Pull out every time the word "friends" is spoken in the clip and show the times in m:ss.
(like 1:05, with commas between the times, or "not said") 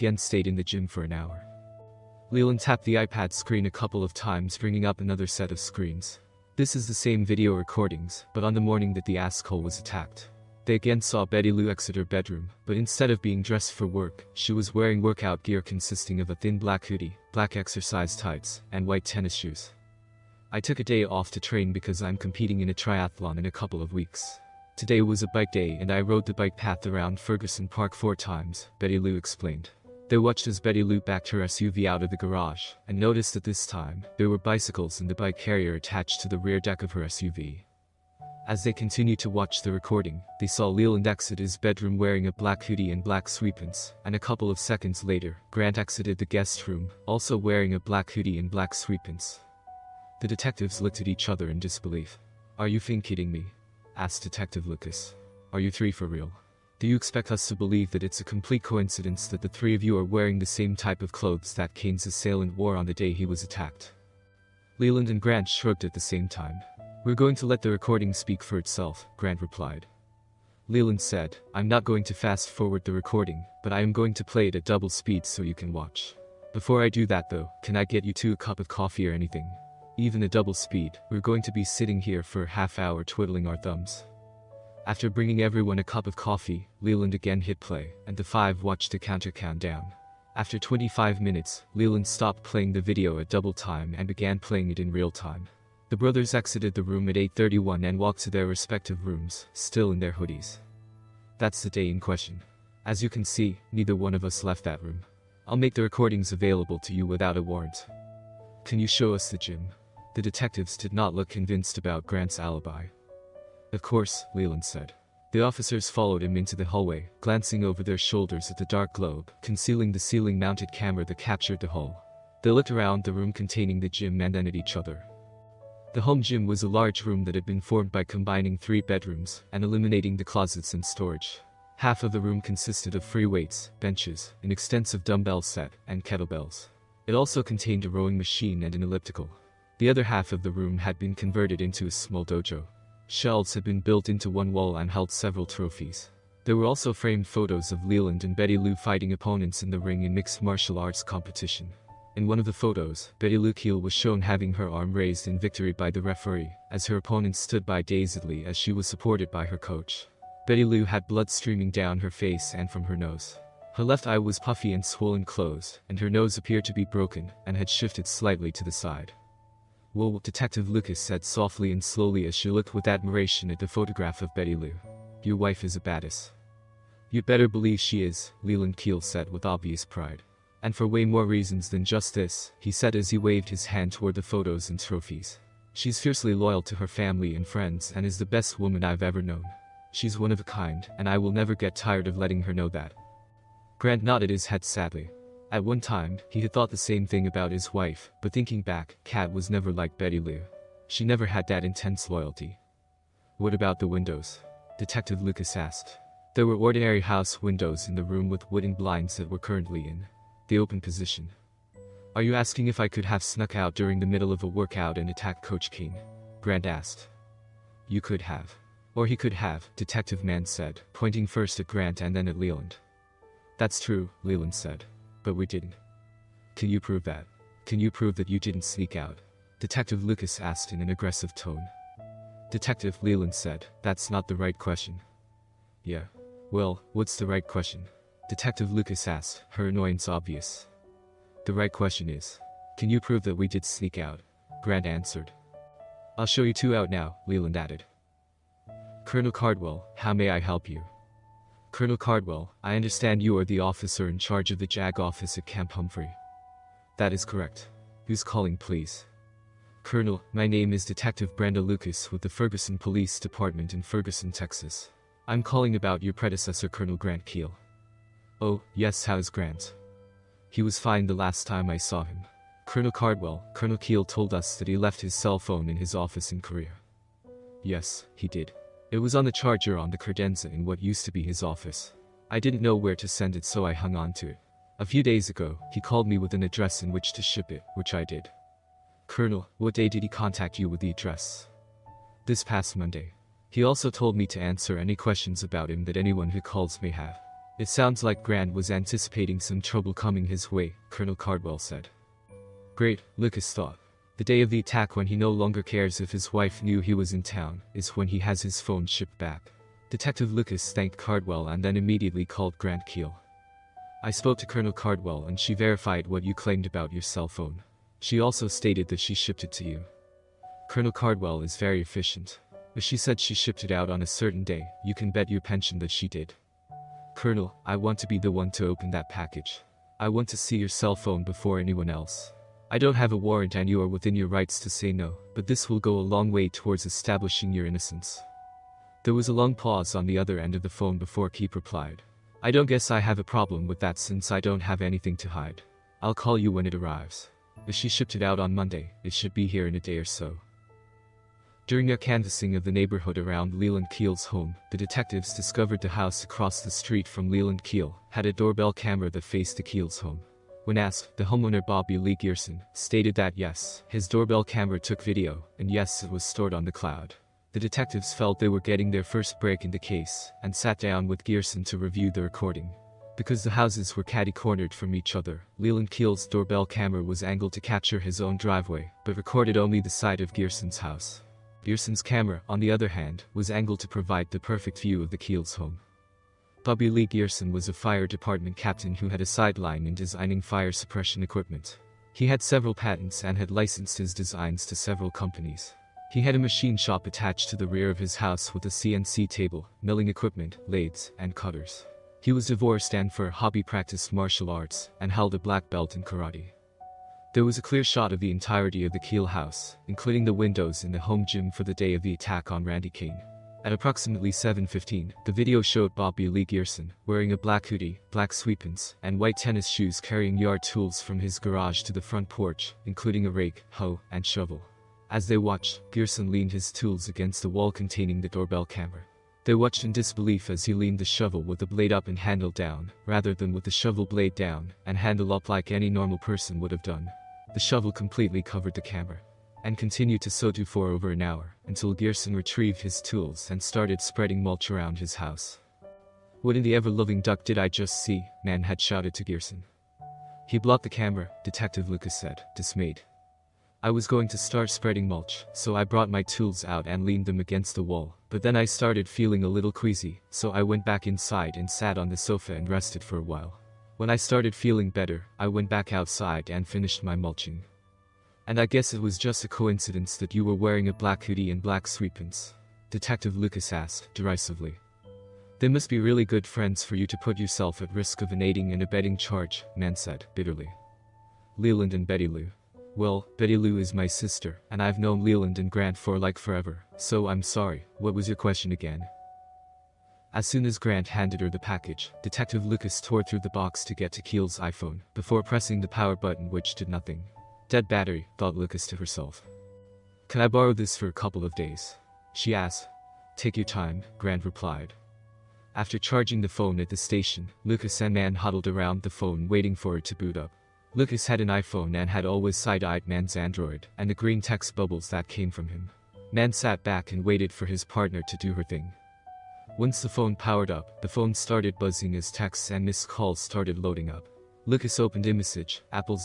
3:07, 7:56.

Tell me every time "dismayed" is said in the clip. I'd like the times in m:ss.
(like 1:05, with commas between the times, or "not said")
7:32.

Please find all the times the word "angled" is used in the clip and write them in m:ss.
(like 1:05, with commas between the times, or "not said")
6:17, 6:23.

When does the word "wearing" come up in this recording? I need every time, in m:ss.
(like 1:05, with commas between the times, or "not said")
0:14, 0:41, 0:47, 1:00, 6:57, 7:50.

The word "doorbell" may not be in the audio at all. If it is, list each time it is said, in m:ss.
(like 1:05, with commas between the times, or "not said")
5:58, 6:04, 6:16, 7:08.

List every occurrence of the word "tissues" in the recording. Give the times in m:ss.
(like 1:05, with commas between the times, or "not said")
not said.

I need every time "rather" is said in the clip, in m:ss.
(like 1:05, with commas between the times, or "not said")
7:13.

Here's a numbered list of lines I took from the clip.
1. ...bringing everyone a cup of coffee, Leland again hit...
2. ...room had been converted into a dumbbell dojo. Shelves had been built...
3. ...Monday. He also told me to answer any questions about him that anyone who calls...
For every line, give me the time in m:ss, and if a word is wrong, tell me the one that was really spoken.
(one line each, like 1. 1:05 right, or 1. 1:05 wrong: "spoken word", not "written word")
1. 1:25 right
2. 2:20 wrong: "small", not "dumbbell"
3. 4:52 right.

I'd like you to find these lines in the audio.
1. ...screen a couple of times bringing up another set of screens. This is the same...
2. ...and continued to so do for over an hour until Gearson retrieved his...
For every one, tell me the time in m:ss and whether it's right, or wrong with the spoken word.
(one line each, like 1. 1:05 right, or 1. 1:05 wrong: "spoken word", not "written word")
1. 0:03 right
2. 7:19 right.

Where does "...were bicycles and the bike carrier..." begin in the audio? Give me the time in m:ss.
0:34.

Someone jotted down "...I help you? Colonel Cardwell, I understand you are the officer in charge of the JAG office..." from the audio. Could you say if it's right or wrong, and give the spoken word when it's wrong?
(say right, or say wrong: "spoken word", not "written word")
right.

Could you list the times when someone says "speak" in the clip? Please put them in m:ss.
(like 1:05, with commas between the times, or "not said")
1:08.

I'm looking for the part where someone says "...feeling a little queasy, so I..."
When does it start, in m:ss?
7:39.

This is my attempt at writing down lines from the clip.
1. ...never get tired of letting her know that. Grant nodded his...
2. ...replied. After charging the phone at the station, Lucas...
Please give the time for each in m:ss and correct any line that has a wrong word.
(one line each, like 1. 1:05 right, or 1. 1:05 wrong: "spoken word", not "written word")
1. 3:11 right
2. 8:24 right.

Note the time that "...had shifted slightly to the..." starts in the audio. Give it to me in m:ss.
2:47.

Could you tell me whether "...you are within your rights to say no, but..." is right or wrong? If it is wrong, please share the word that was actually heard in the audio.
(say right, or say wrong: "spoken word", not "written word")
right.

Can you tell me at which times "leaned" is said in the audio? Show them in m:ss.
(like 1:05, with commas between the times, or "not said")
7:06, 7:10, 7:37.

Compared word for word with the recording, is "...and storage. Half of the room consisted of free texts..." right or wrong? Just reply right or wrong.
wrong.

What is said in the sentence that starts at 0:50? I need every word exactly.
The detectives looked at each other in disbelief.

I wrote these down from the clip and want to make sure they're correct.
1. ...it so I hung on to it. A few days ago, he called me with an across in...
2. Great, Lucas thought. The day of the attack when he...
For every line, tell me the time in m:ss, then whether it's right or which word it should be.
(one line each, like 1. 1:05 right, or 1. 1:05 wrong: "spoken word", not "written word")
1. 4:43 wrong: "address", not "across"
2. 5:02 right.